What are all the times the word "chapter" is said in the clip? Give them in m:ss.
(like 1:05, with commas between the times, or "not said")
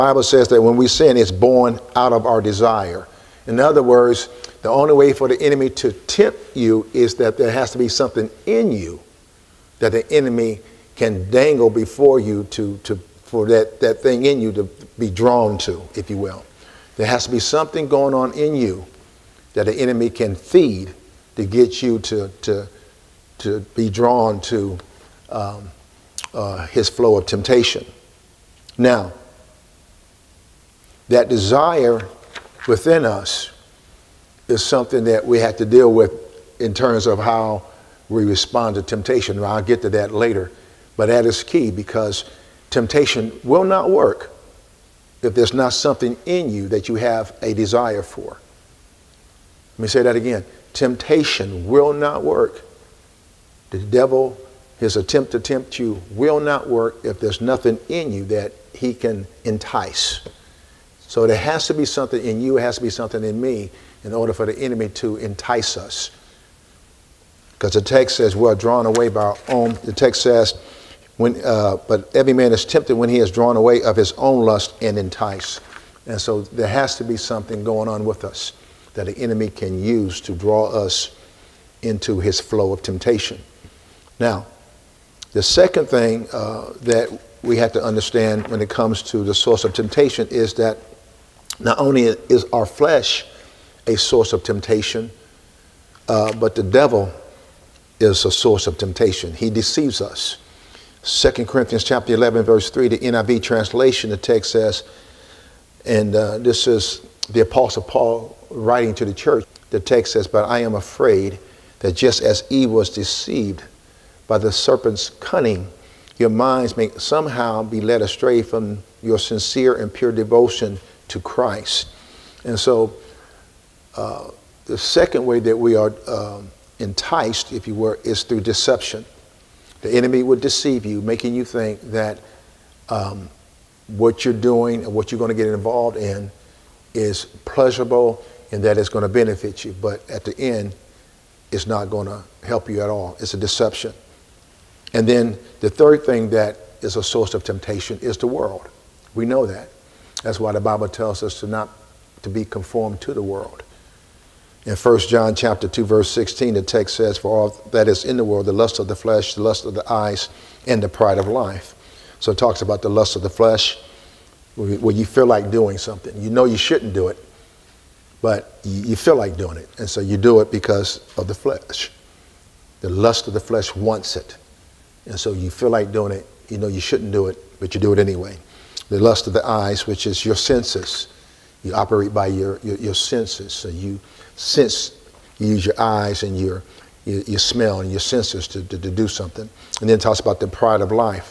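1:41, 2:35.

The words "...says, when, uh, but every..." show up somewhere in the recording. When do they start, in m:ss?
1:10.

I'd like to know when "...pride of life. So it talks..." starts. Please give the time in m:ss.
2:40.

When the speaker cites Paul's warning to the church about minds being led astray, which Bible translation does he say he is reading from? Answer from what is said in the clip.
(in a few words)
NIV.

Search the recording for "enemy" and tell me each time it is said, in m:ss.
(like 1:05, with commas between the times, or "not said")
0:05, 0:10, 0:19, 1:04, 1:19, 2:09.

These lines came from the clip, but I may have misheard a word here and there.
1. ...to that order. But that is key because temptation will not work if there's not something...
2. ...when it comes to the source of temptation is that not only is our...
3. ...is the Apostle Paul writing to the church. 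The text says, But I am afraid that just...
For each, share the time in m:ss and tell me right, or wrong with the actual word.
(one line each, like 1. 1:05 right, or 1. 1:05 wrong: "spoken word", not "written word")
1. 0:39 wrong: "later", not "order"
2. 1:28 right
3. 1:46 right.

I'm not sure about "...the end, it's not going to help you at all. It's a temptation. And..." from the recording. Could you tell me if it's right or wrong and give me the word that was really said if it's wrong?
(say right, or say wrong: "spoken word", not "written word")
wrong: "deception", not "temptation".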